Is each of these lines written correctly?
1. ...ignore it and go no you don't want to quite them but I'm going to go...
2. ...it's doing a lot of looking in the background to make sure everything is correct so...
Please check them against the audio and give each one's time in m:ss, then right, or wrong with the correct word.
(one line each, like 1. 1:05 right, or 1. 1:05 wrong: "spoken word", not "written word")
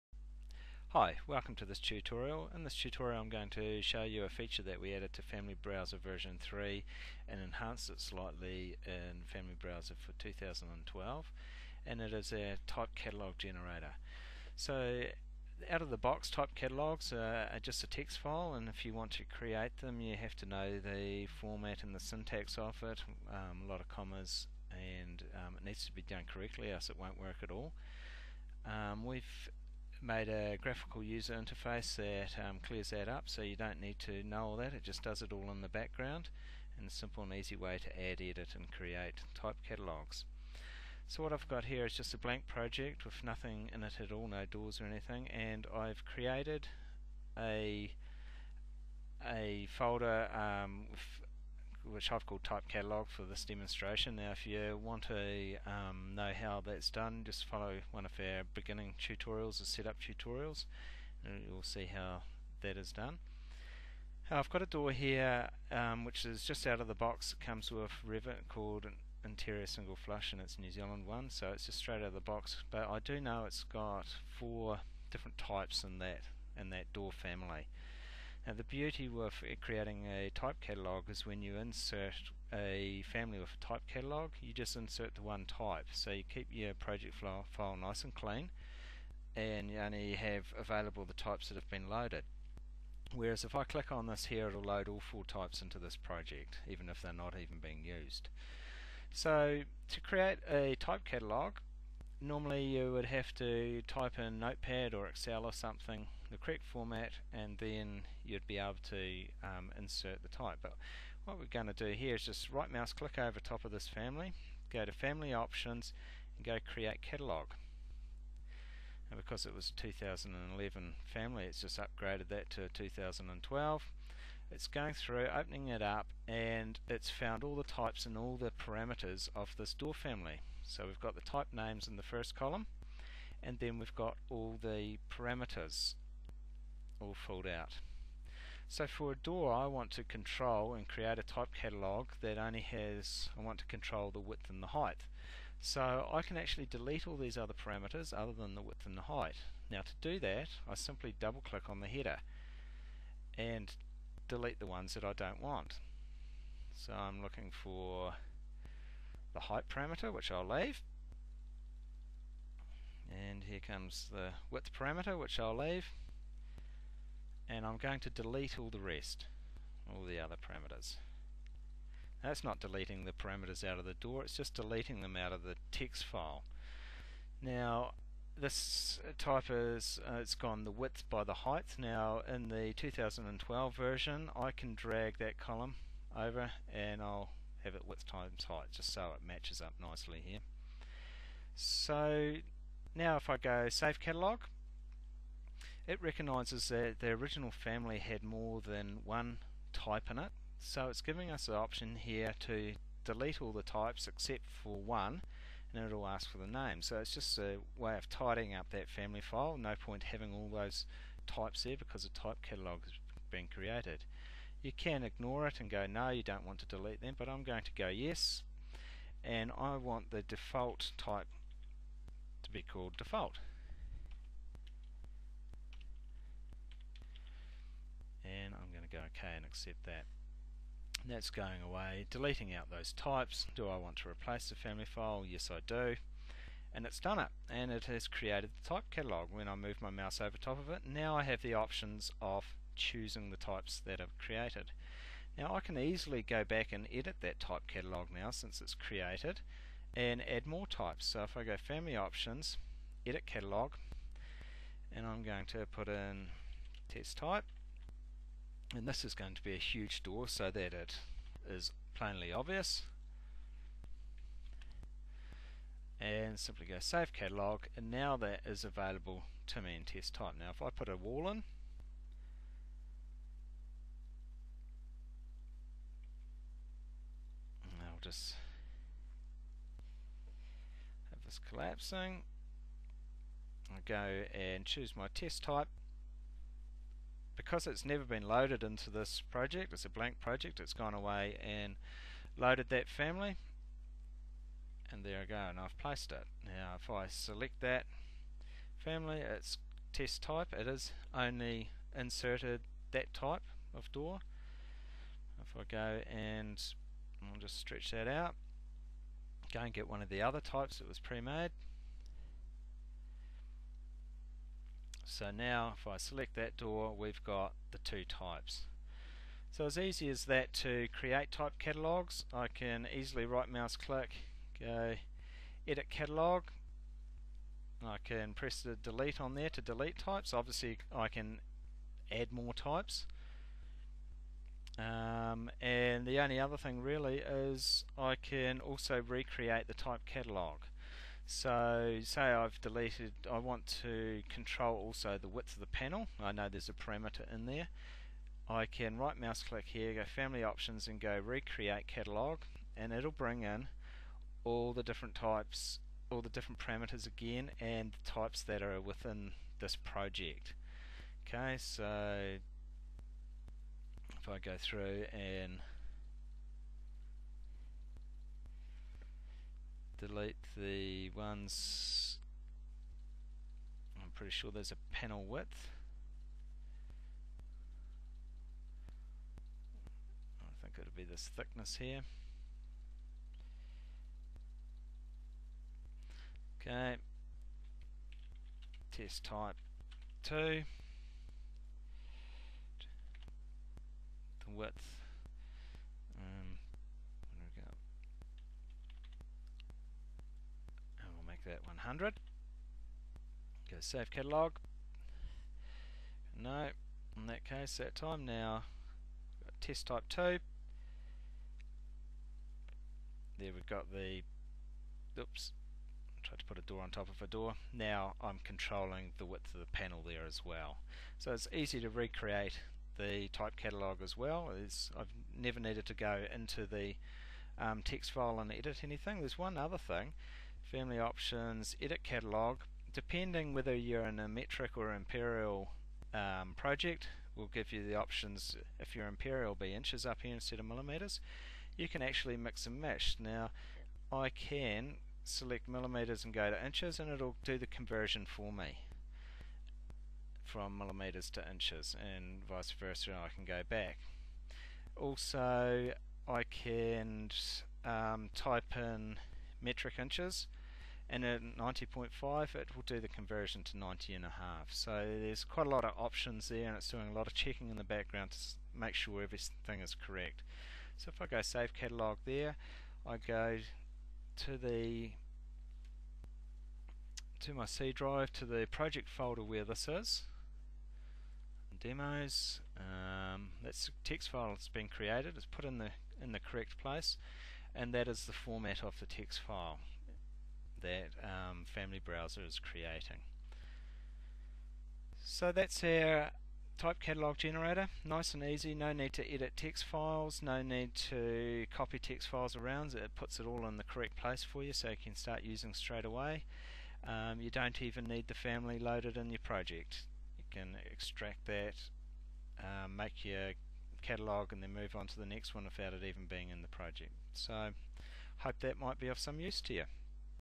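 1. 3:35 wrong: "delete", not "quite"
2. 7:46 wrong: "checking", not "looking".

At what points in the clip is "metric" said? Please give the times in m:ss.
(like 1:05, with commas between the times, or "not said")
7:14, 7:39.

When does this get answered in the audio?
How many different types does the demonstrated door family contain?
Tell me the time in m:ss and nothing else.
1:14.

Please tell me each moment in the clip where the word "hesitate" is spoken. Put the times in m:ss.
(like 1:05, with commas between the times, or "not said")
not said.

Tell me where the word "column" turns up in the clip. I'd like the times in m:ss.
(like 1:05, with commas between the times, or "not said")
2:12, 3:05.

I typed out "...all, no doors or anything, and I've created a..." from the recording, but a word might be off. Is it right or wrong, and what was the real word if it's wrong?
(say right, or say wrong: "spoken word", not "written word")
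right.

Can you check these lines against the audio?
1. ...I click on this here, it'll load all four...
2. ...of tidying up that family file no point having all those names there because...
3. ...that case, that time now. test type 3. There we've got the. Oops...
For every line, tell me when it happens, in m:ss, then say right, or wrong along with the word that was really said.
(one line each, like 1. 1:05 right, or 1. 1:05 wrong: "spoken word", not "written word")
1. 1:33 right
2. 3:27 wrong: "types", not "names"
3. 6:47 wrong: "2", not "3".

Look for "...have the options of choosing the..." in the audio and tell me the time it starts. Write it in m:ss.
4:01.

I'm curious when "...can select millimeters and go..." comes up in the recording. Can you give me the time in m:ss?
7:24.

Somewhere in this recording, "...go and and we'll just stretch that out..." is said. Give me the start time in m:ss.
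5:05.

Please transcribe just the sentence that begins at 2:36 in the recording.
So I'm looking for the height parameter, which I'll leave.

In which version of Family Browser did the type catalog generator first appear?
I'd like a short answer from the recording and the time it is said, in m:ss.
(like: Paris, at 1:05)
Version 3, at 0:05.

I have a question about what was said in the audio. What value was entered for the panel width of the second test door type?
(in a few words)
100.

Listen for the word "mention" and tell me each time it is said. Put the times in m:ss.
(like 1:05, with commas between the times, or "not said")
not said.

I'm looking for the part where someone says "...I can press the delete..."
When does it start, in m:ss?
5:27.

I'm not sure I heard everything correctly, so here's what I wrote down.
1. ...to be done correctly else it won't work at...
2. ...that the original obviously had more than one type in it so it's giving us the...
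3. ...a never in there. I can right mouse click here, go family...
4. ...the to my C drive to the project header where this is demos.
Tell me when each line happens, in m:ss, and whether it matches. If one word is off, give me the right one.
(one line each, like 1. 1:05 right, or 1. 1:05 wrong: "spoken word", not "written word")
1. 0:25 right
2. 3:16 wrong: "family", not "obviously"
3. 5:46 wrong: "parameter", not "never"
4. 7:54 wrong: "folder", not "header".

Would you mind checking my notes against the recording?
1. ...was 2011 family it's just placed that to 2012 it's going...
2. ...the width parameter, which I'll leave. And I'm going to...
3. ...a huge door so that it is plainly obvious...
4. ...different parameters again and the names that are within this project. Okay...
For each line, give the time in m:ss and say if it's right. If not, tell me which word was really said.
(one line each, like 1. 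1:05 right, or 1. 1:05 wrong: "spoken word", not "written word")
1. 1:59 wrong: "upgraded", not "placed"
2. 2:44 right
3. 4:19 right
4. 5:56 wrong: "types", not "names".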